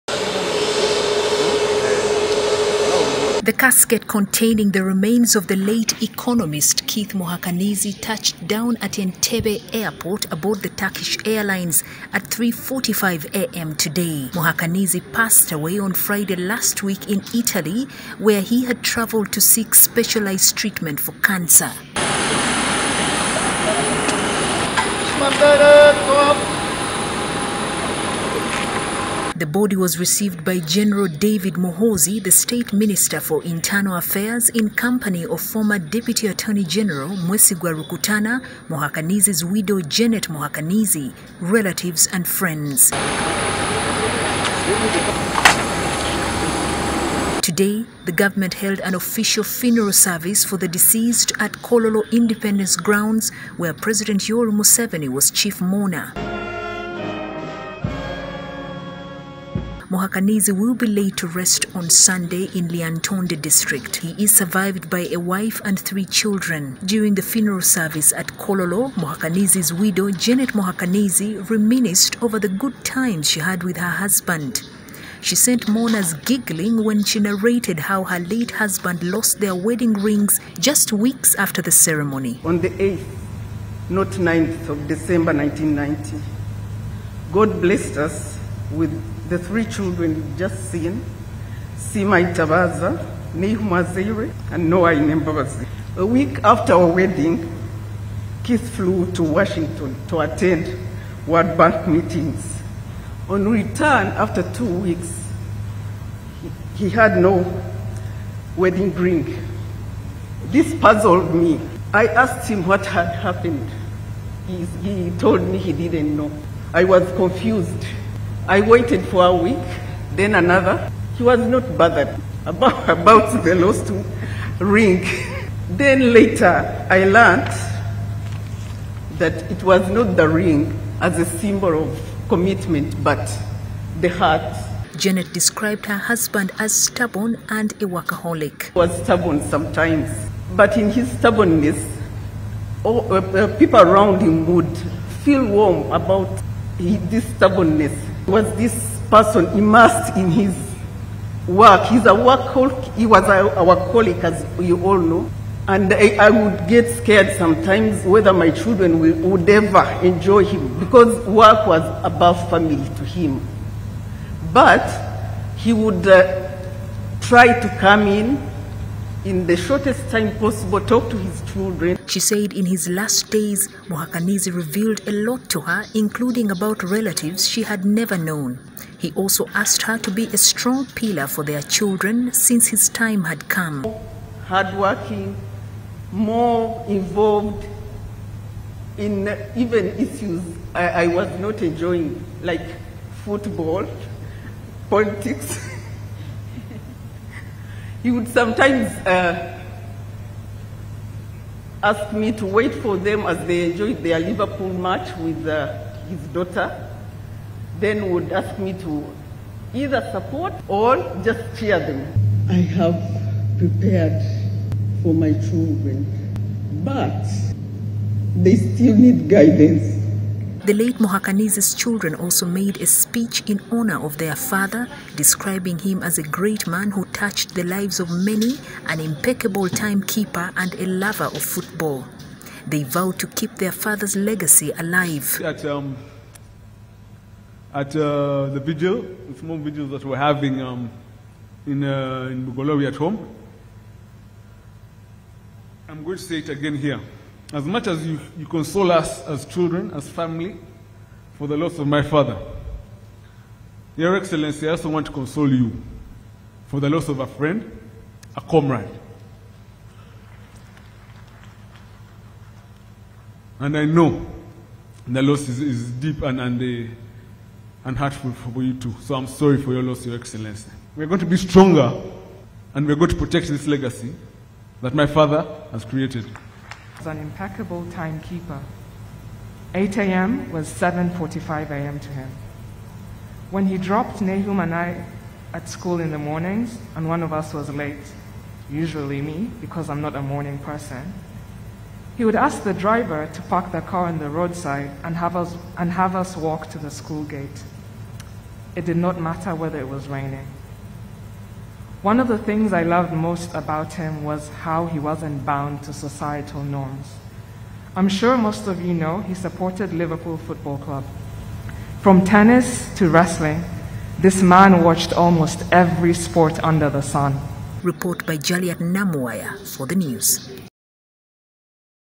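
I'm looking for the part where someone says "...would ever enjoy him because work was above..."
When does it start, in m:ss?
2:39.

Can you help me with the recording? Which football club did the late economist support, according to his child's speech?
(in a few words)
Liverpool Football Club.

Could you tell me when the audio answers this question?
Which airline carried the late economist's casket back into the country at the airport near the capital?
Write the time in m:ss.
0:10.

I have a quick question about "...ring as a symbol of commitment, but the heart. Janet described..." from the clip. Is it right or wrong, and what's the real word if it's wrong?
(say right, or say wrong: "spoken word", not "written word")
right.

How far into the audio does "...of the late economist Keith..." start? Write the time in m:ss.
0:05.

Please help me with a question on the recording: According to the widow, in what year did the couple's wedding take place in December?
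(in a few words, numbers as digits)
1990.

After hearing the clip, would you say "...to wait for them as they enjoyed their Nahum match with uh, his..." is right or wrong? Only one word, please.
wrong.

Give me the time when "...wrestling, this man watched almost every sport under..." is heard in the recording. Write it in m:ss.
5:13.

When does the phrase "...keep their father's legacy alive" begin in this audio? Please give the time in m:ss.
3:53.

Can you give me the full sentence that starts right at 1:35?
A week after our wedding, Keith flew to Washington to attend World Bank meetings.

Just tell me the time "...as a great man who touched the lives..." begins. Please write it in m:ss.
3:46.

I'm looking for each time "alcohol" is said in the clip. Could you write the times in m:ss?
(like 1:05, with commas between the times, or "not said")
not said.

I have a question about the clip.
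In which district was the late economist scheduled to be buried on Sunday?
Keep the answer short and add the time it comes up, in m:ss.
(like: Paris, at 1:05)
Lyantonde, at 1:02.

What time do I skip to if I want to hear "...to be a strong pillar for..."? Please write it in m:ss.
2:59.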